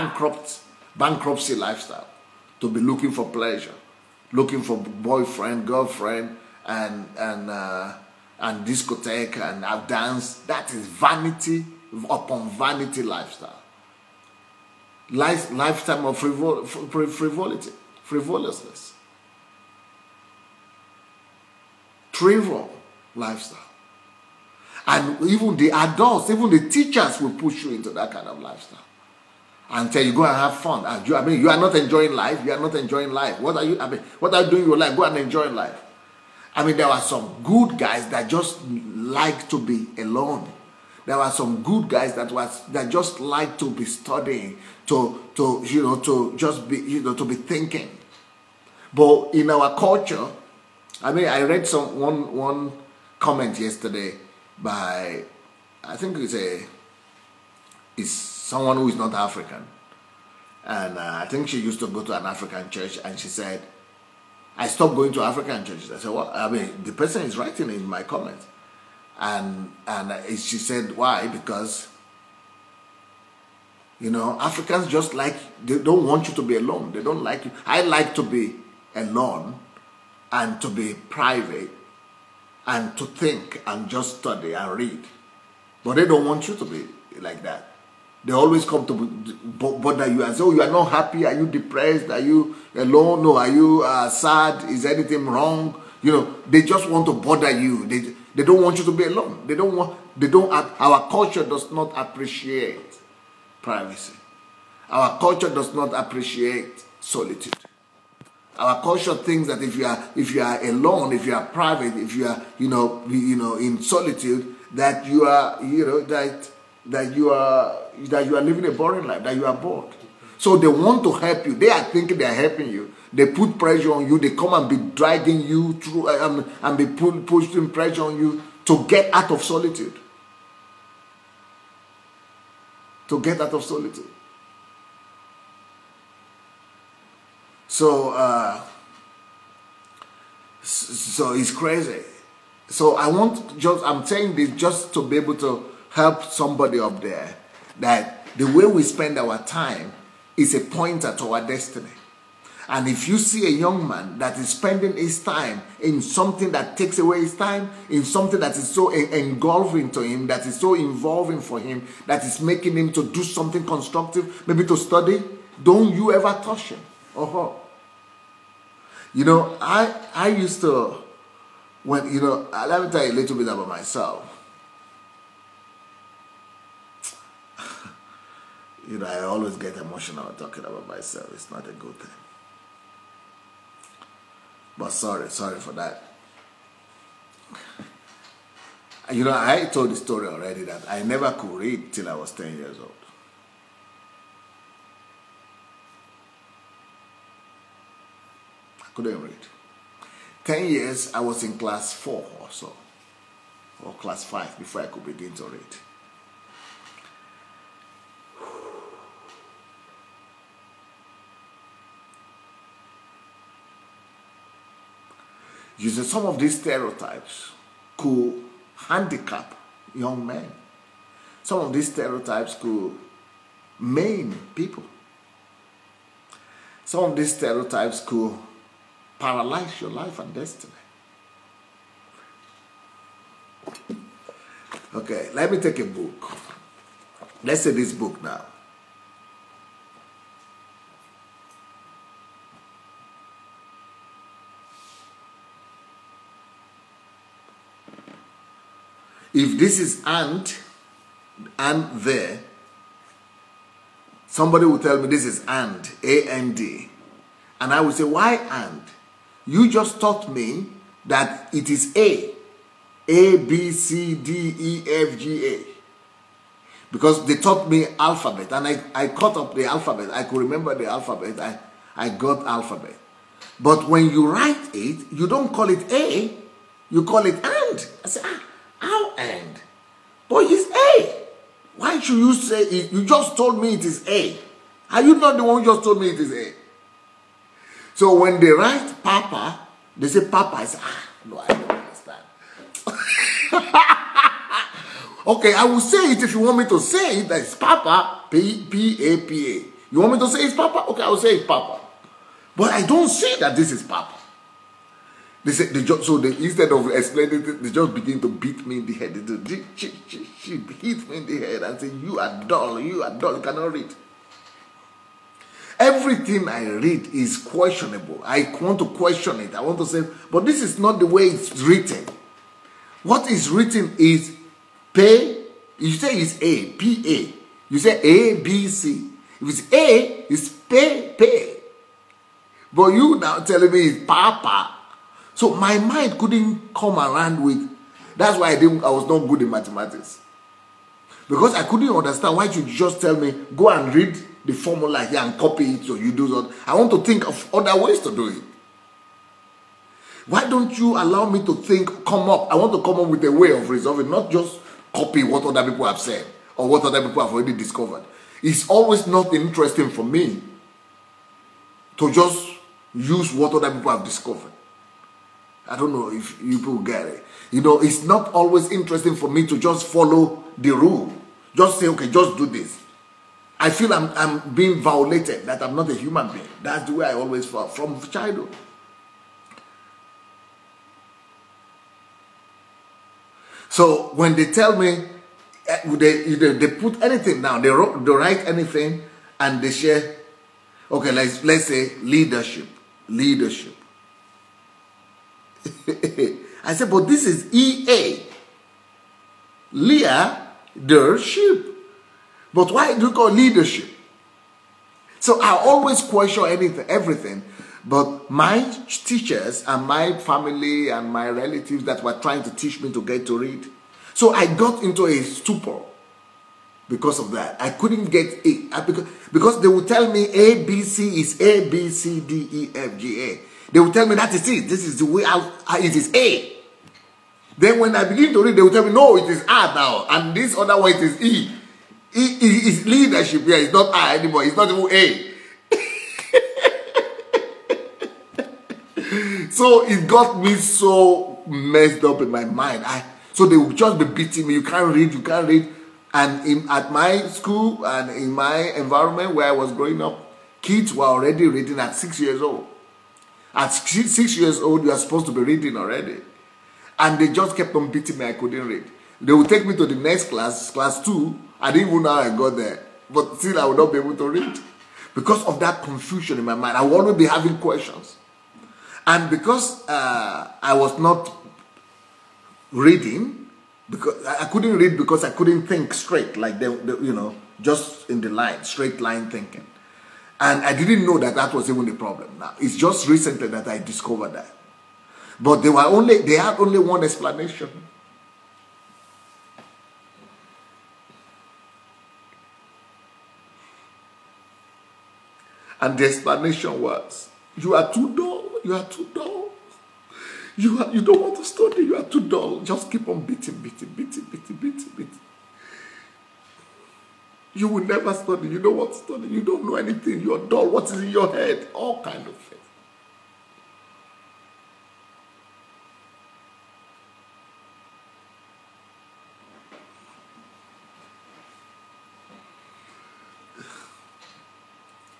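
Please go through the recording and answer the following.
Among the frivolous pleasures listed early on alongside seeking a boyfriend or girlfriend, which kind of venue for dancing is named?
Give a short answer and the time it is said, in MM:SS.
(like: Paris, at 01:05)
discotheque, at 00:08.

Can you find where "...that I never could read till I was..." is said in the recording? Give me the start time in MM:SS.
03:10.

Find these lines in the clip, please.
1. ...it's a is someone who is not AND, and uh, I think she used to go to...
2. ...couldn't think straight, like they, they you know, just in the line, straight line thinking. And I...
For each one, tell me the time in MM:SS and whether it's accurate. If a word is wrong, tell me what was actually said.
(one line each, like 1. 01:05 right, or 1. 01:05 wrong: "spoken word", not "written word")
1. 00:56 wrong: "African", not "AND"
2. 07:55 right.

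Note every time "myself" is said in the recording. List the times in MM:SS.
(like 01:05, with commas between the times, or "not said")
02:53, 03:00.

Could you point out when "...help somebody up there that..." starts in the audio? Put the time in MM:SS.
02:25.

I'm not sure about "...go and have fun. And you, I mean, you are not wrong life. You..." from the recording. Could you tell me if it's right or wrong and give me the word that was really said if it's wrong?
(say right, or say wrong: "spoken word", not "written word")
wrong: "enjoying", not "wrong".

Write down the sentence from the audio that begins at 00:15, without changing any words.
Life, lifetime of frivol, frivolity, frivolousness.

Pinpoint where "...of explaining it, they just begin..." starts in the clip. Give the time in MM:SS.
05:06.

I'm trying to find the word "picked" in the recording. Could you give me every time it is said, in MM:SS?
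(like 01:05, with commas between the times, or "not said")
not said.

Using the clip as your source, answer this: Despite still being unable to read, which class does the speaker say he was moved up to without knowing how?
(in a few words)
class two.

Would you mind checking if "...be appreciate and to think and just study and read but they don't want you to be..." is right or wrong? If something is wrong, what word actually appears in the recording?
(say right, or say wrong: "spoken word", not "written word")
wrong: "private", not "appreciate".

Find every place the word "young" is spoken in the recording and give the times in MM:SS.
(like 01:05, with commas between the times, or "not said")
02:33, 03:39.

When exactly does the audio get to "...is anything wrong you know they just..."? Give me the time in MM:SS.
01:34.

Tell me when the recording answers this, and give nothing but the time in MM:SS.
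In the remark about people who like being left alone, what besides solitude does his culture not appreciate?
01:43.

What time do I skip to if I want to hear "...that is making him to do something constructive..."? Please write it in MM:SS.
02:42.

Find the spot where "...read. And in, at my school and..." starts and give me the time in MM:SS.
07:25.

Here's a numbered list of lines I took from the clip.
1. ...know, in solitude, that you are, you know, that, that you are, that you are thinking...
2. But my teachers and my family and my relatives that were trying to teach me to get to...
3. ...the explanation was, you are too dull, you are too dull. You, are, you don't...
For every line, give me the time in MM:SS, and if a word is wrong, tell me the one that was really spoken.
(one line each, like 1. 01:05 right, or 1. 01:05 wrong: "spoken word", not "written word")
1. 01:53 wrong: "living", not "thinking"
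2. 06:47 right
3. 08:15 right.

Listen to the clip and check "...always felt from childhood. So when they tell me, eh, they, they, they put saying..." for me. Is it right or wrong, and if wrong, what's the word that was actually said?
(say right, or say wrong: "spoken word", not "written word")
wrong: "anything", not "saying".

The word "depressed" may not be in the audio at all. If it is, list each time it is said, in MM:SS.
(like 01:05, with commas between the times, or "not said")
01:31.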